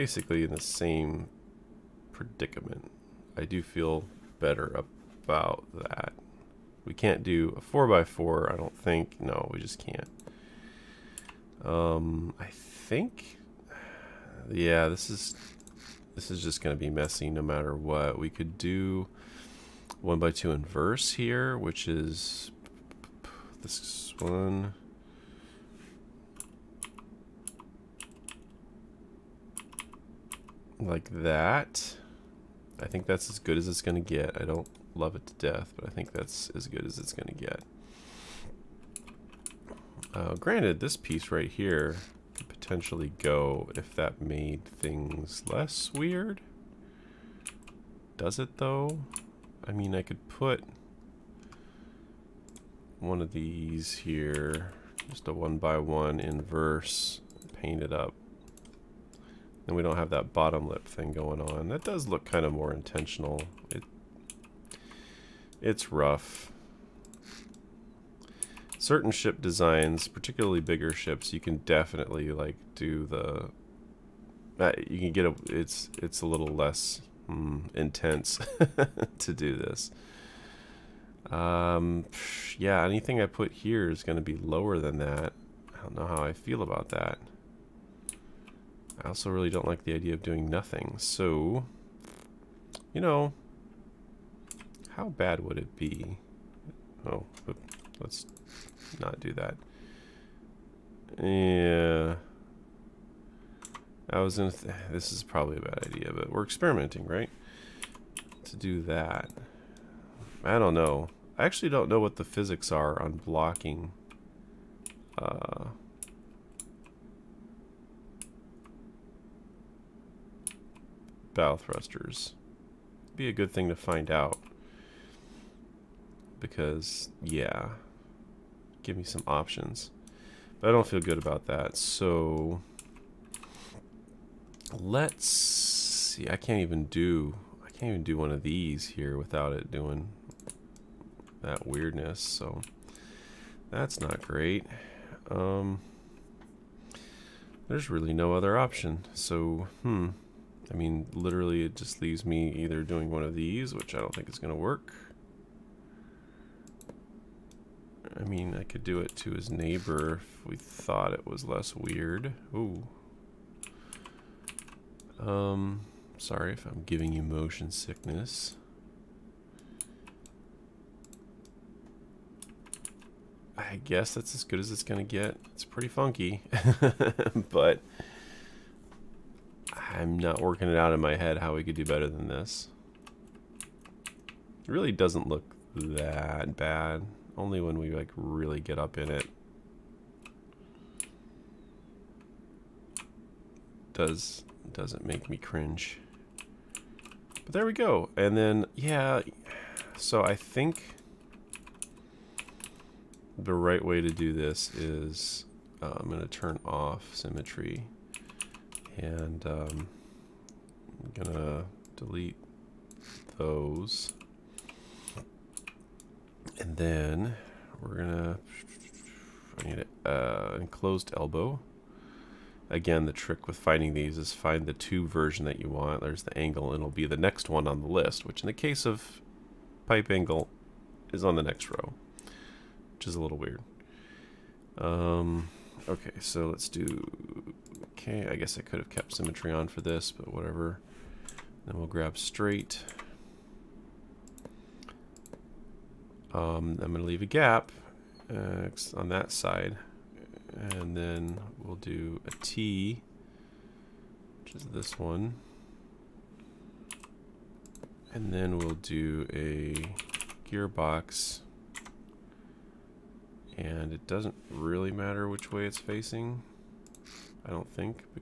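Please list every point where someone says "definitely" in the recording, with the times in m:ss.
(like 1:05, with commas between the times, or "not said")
1:11.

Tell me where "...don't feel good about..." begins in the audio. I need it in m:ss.
2:10.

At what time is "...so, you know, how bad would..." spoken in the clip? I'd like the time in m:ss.
1:30.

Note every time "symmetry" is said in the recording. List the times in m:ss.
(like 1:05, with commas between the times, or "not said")
3:27, 3:59.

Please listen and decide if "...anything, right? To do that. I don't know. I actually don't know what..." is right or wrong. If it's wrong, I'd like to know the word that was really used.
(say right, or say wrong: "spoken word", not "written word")
wrong: "experimenting", not "anything".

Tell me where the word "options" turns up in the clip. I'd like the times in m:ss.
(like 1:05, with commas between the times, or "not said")
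2:09, 2:28.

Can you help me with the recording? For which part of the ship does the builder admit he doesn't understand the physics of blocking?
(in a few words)
bow thrusters.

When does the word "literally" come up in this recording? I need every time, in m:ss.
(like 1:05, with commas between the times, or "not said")
2:31.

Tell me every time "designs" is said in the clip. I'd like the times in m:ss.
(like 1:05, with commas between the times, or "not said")
1:09.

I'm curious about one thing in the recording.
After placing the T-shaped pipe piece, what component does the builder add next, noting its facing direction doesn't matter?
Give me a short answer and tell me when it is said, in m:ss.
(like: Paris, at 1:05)
gearbox, at 4:20.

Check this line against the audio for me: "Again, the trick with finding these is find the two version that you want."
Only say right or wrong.
right.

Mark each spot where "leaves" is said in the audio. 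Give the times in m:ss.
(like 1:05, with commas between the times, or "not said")
2:32, 4:07.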